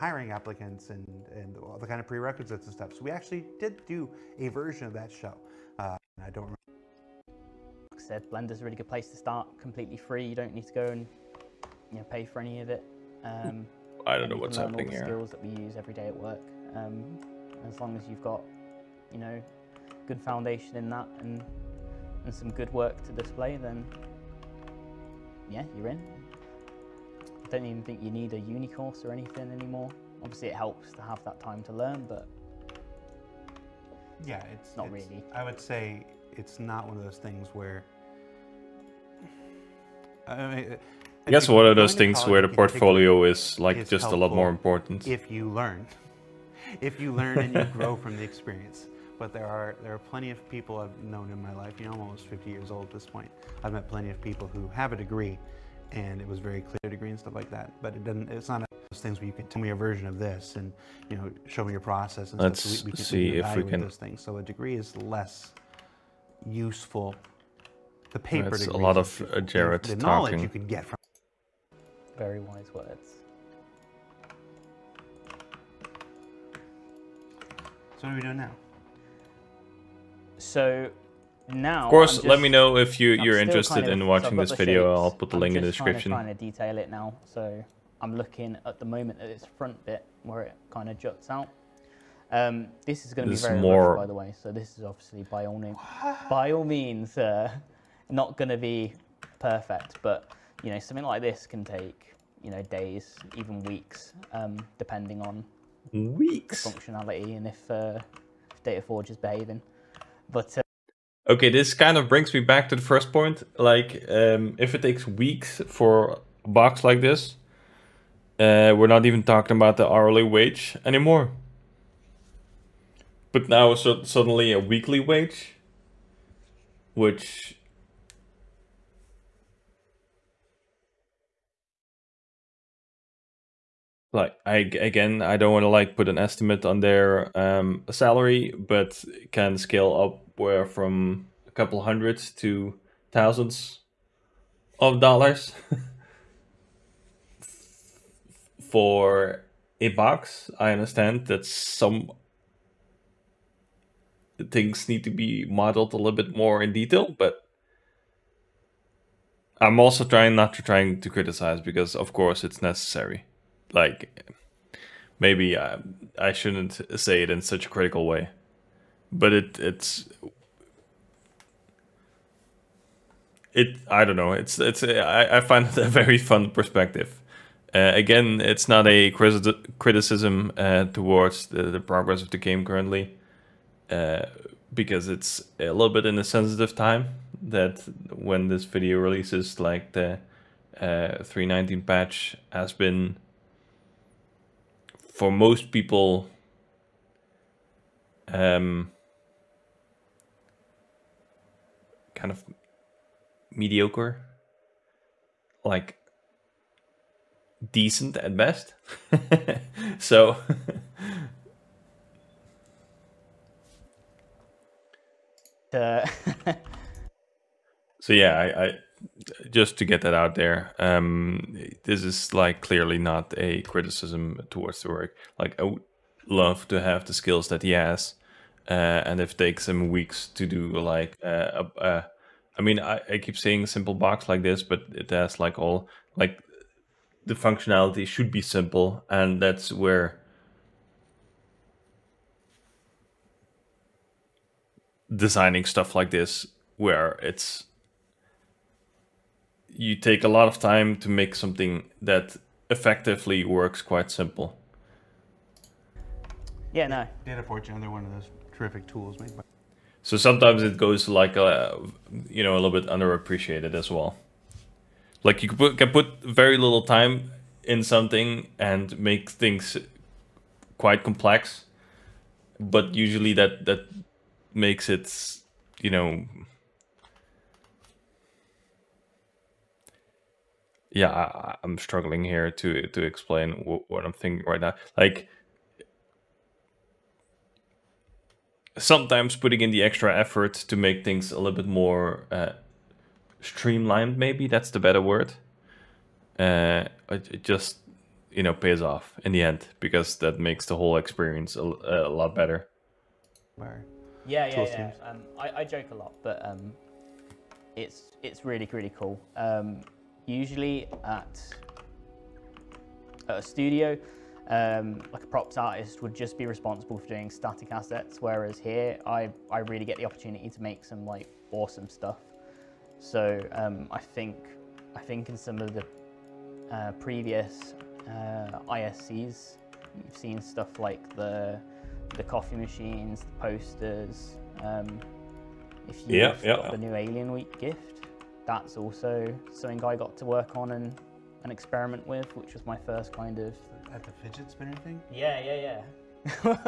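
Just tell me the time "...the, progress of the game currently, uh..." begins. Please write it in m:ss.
3:01.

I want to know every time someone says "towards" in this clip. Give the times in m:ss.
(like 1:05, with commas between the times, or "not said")
3:00, 3:44.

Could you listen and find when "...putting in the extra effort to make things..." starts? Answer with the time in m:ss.
4:49.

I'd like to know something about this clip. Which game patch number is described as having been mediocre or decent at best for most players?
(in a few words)
3.19.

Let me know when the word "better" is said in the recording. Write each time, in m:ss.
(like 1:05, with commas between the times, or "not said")
4:54, 5:02.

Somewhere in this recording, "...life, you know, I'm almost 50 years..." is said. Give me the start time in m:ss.
0:51.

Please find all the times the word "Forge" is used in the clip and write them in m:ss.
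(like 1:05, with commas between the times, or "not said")
1:48, 4:17.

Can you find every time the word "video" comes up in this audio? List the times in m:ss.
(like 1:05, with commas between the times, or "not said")
1:24, 3:08.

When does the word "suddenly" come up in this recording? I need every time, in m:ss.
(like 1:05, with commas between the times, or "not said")
2:04.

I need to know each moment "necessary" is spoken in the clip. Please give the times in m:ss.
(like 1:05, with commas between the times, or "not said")
2:42.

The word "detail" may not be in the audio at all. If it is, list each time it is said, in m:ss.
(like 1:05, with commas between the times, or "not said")
1:26, 2:36.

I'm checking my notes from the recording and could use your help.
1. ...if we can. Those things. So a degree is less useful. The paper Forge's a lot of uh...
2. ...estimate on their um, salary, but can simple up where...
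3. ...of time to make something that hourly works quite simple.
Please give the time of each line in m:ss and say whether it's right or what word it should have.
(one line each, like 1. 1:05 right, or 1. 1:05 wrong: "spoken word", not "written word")
1. 1:03 wrong: "That", not "Forge"
2. 2:16 wrong: "scale", not "simple"
3. 4:10 wrong: "effectively", not "hourly".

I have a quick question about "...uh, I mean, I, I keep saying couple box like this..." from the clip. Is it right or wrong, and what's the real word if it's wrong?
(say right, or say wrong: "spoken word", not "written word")
wrong: "simple", not "couple".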